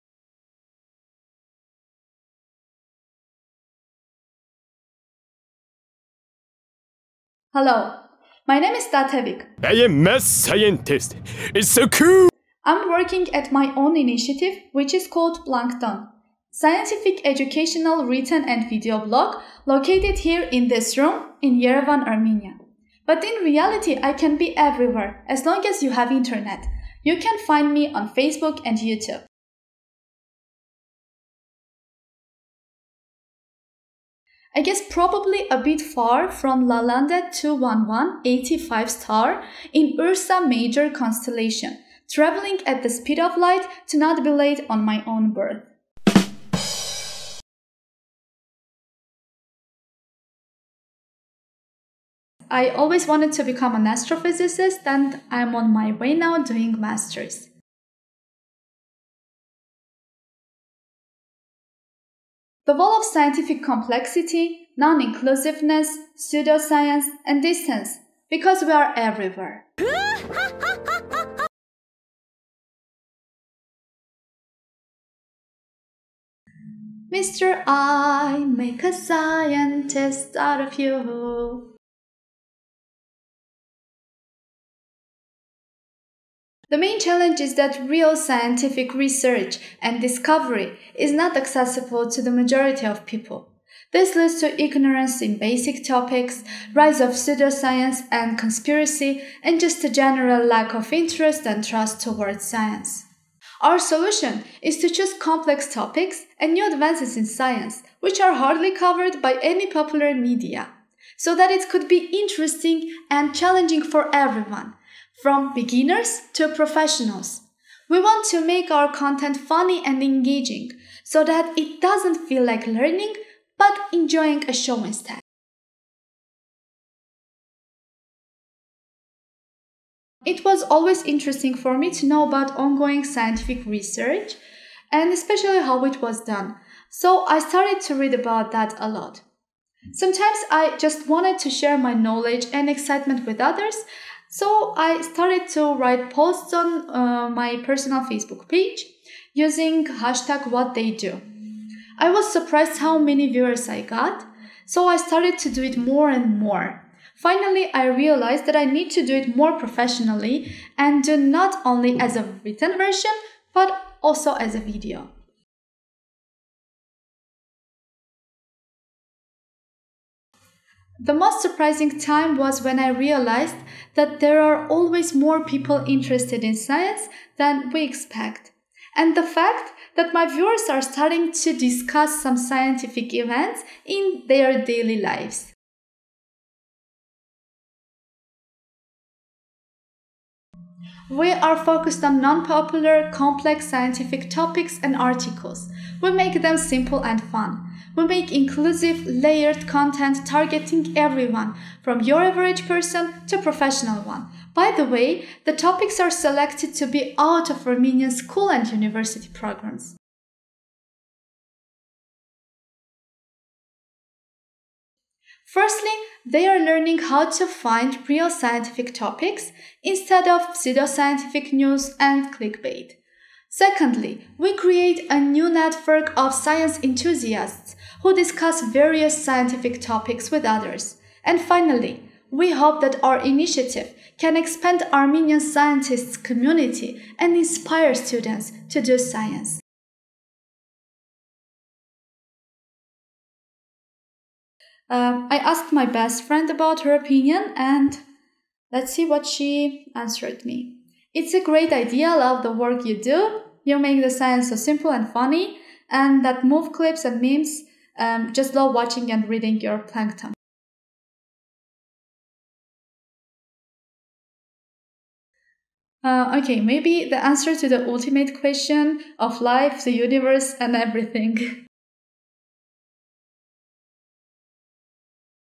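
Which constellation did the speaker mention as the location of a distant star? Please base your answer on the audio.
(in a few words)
Ursa Major.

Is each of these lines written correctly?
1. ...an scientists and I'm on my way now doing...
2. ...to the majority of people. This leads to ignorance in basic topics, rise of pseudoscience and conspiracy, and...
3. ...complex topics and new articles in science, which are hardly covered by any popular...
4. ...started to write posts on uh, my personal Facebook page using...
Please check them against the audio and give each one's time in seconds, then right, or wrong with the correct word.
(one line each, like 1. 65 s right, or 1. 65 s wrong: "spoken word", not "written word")
1. 53 s wrong: "astrophysicist", not "scientists"
2. 92 s right
3. 105 s wrong: "advances", not "articles"
4. 145 s right.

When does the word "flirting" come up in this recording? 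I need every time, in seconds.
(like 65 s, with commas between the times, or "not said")
not said.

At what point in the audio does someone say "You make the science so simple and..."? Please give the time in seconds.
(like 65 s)
253 s.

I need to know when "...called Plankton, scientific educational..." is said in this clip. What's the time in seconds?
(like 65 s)
15 s.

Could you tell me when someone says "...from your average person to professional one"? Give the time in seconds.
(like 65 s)
201 s.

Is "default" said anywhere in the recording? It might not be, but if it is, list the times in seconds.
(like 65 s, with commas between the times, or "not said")
not said.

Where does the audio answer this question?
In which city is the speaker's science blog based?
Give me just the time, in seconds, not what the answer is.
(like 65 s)
21 s.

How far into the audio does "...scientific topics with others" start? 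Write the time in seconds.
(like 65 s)
229 s.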